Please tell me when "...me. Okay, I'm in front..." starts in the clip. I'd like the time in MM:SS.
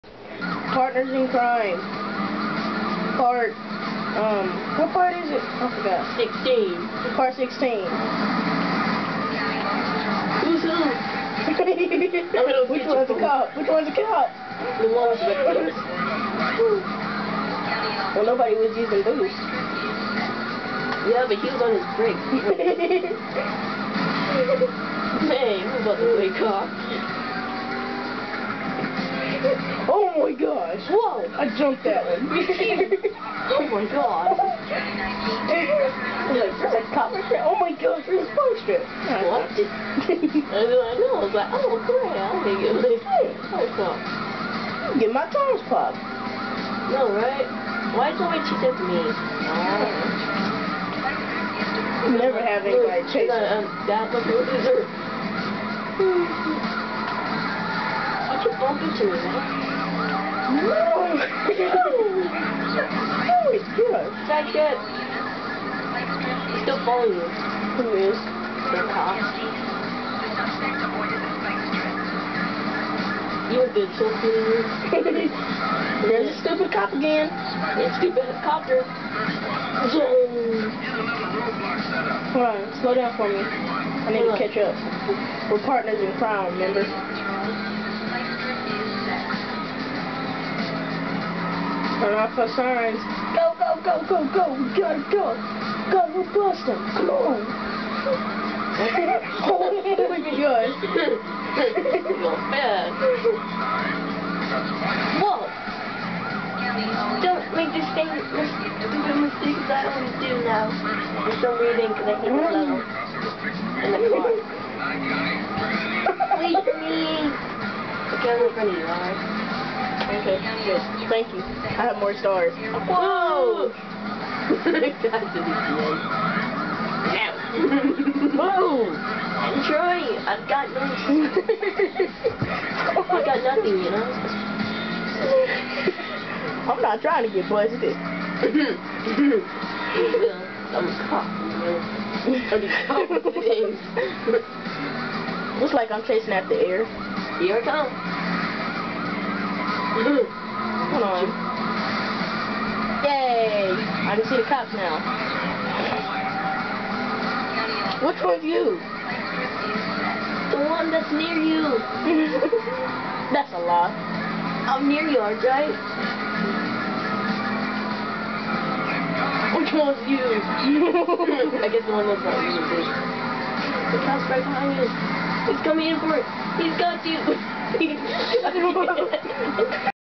01:56.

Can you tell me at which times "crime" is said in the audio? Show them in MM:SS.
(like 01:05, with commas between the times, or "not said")
00:01, 01:26.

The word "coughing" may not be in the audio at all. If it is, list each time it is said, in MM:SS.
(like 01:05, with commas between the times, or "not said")
02:22.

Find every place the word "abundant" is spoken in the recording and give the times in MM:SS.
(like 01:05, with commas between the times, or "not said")
not said.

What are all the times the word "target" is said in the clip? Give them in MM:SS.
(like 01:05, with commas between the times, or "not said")
not said.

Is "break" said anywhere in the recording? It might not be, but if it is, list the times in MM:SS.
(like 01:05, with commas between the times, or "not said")
00:21.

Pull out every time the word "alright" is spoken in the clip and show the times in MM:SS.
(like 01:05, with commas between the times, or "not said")
01:58.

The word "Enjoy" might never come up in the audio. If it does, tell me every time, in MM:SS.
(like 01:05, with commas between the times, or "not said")
02:09.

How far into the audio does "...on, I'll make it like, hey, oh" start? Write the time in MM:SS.
00:42.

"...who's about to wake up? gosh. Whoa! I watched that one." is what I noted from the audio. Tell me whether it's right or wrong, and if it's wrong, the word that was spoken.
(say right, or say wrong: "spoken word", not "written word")
wrong: "jumped", not "watched".